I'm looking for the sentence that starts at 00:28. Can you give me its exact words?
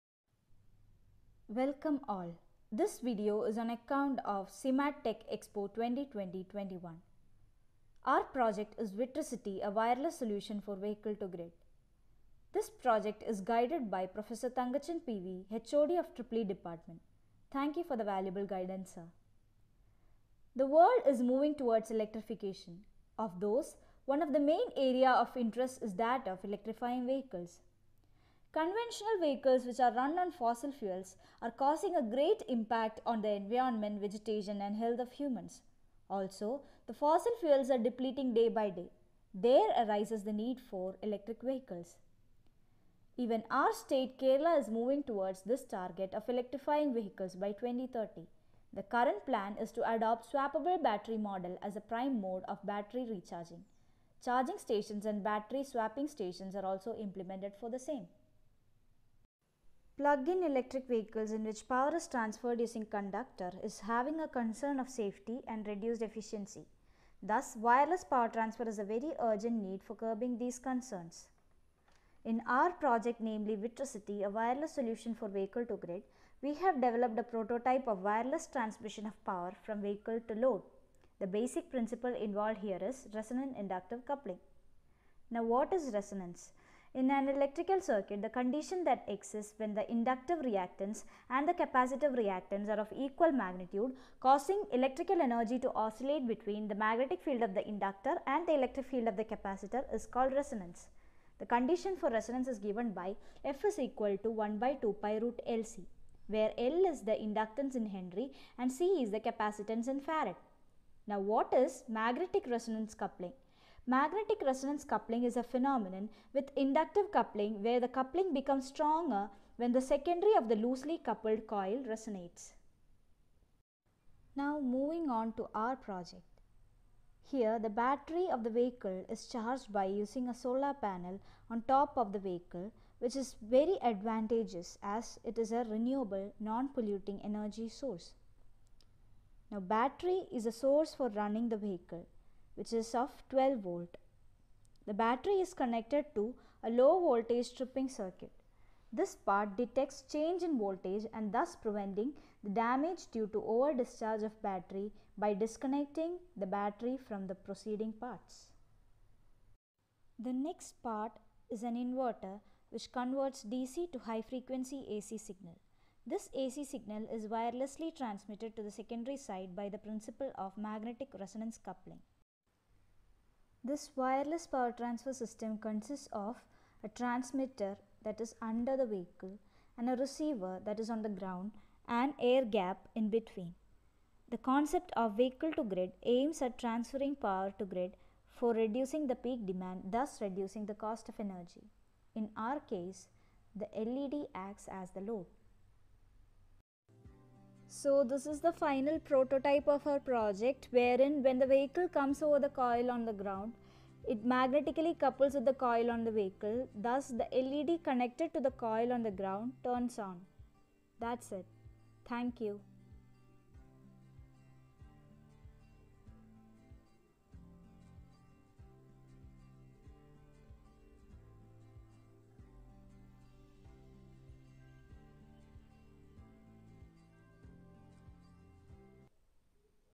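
Conventional vehicles which are run on fossil fuels are causing a great impact on the environment, vegetation and health of humans.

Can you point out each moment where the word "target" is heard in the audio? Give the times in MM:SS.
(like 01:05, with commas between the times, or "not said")
00:45.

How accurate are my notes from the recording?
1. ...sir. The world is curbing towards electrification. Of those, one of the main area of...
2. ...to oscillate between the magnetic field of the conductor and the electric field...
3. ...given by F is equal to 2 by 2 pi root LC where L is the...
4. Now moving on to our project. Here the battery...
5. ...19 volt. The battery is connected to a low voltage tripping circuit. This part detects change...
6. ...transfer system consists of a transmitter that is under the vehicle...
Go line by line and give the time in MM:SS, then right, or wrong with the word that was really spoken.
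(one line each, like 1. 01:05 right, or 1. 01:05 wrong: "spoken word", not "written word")
1. 00:18 wrong: "moving", not "curbing"
2. 01:35 wrong: "inductor", not "conductor"
3. 01:42 wrong: "1", not "2"
4. 02:04 right
5. 02:23 wrong: "12", not "19"
6. 02:54 right.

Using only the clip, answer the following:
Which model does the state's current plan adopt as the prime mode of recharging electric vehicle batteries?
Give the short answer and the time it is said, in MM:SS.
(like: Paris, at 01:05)
Swappable battery model, at 00:50.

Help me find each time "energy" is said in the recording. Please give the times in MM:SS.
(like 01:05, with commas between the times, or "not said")
01:35, 02:17, 03:11.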